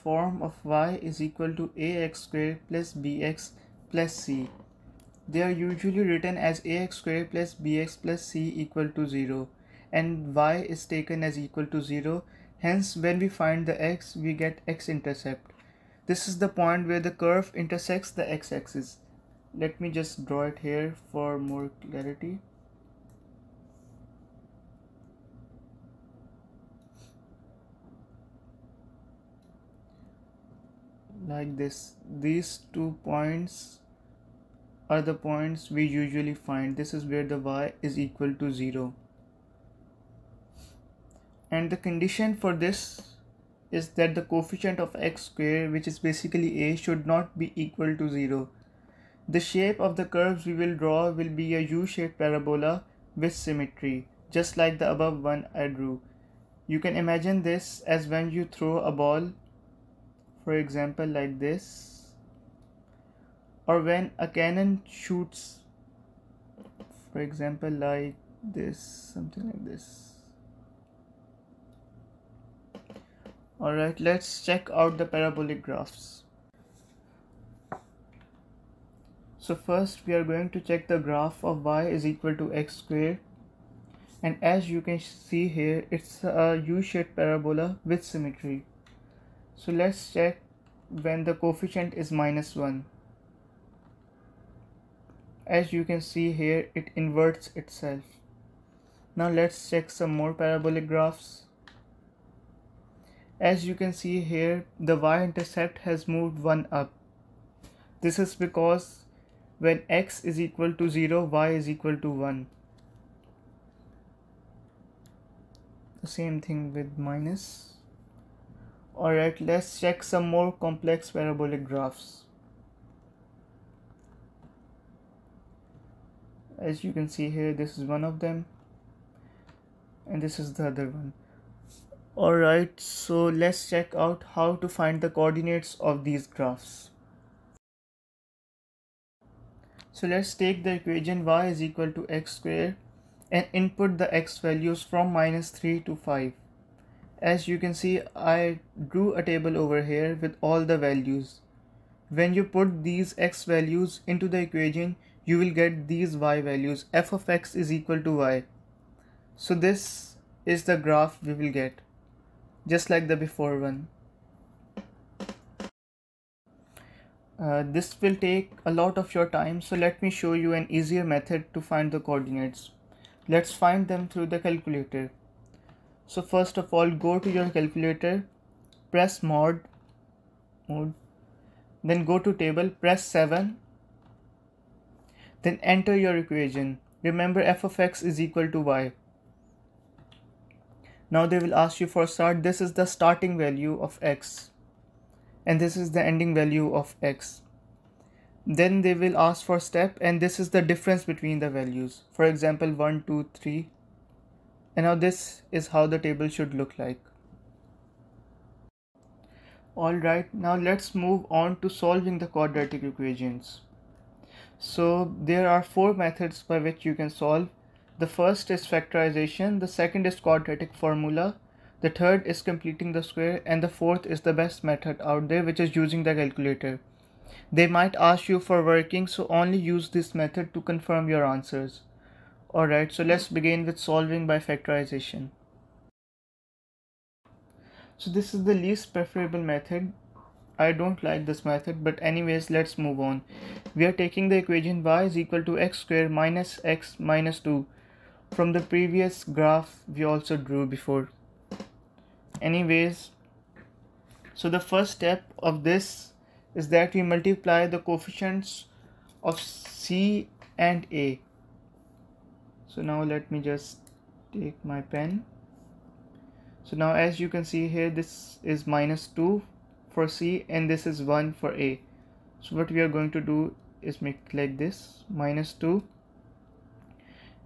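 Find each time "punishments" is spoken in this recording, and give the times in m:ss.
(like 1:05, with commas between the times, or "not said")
not said.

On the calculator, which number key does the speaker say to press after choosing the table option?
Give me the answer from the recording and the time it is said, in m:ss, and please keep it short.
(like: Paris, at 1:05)
7, at 3:03.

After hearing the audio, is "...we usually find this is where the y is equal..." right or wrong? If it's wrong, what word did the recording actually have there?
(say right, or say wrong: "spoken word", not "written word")
right.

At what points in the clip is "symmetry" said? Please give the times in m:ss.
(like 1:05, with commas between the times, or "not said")
0:53, 1:28.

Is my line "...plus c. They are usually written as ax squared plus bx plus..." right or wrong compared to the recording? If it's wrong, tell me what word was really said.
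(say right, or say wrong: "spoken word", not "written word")
right.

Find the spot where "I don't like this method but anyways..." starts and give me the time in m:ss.
4:00.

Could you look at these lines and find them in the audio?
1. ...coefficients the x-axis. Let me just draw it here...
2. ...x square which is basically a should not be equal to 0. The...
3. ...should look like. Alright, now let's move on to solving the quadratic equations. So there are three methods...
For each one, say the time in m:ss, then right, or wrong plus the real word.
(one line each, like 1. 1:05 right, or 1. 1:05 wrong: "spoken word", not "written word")
1. 0:17 wrong: "intersects", not "coefficients"
2. 0:44 right
3. 3:26 wrong: "four", not "three".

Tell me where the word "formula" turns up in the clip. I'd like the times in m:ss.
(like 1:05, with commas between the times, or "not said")
3:40.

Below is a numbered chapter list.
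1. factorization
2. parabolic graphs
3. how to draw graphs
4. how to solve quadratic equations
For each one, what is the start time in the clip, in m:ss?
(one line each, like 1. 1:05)
1. 3:57
2. 1:19
3. 2:19
4. 3:34.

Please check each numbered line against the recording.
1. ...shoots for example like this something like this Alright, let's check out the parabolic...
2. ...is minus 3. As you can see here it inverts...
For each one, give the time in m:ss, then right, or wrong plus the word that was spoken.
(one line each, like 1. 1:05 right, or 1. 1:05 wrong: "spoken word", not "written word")
1. 1:04 right
2. 1:31 wrong: "1", not "3".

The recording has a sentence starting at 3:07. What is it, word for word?
Remember f of x is equal to y.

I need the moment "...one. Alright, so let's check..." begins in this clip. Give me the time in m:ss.
2:10.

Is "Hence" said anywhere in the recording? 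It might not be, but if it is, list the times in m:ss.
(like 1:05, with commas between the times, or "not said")
0:12.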